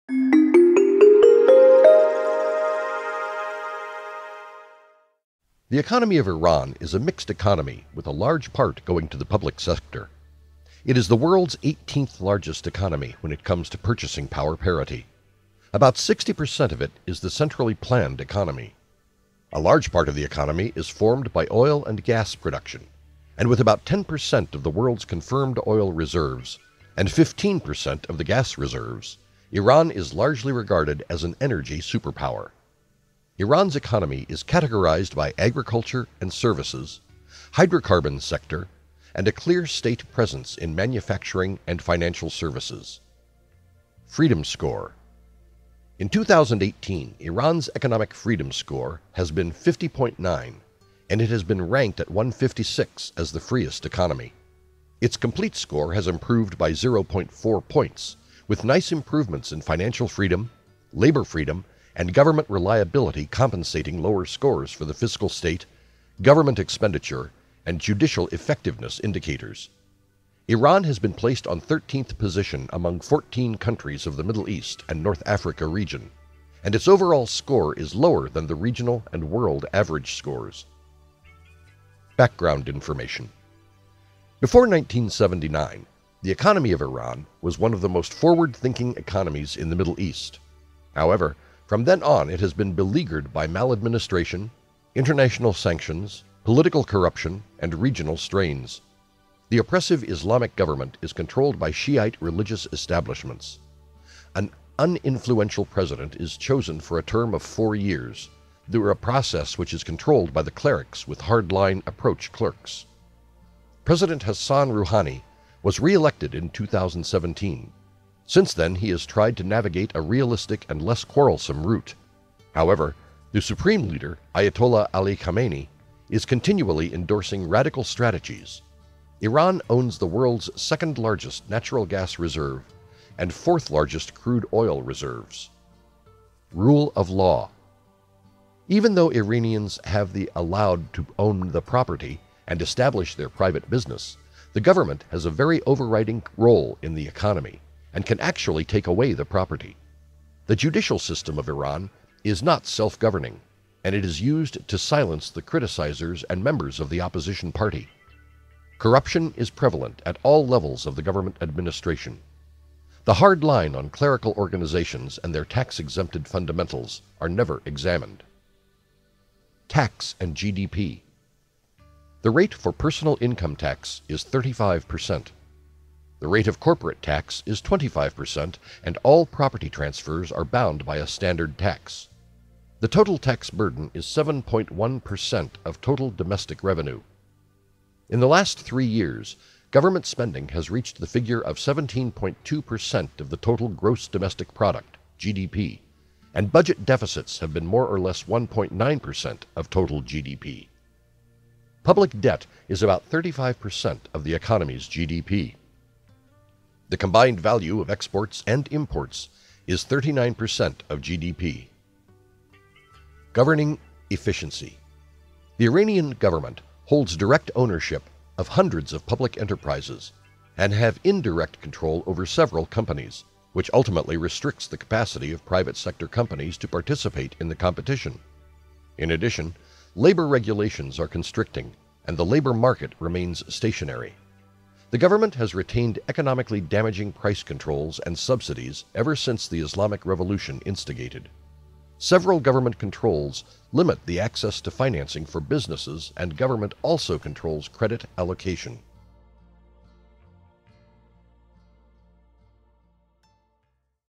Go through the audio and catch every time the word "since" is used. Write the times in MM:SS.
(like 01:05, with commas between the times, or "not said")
01:58, 03:59.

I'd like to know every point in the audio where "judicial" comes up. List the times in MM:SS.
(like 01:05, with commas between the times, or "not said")
01:07, 02:30.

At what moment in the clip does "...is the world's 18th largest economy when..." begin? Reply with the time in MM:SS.
00:10.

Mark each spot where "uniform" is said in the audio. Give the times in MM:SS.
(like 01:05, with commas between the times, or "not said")
not said.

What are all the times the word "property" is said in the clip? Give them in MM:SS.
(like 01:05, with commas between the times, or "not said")
02:21, 02:29, 02:59.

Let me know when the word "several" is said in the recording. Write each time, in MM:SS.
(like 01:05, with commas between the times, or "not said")
03:42, 04:01.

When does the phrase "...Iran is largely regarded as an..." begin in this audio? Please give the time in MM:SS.
00:29.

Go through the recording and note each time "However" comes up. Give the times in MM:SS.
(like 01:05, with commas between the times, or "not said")
01:30, 02:02.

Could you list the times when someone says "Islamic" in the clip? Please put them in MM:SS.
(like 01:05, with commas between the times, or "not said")
01:40, 03:59.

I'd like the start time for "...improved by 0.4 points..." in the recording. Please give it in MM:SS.
00:56.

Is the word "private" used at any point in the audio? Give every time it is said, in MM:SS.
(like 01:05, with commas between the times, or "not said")
02:23, 03:45.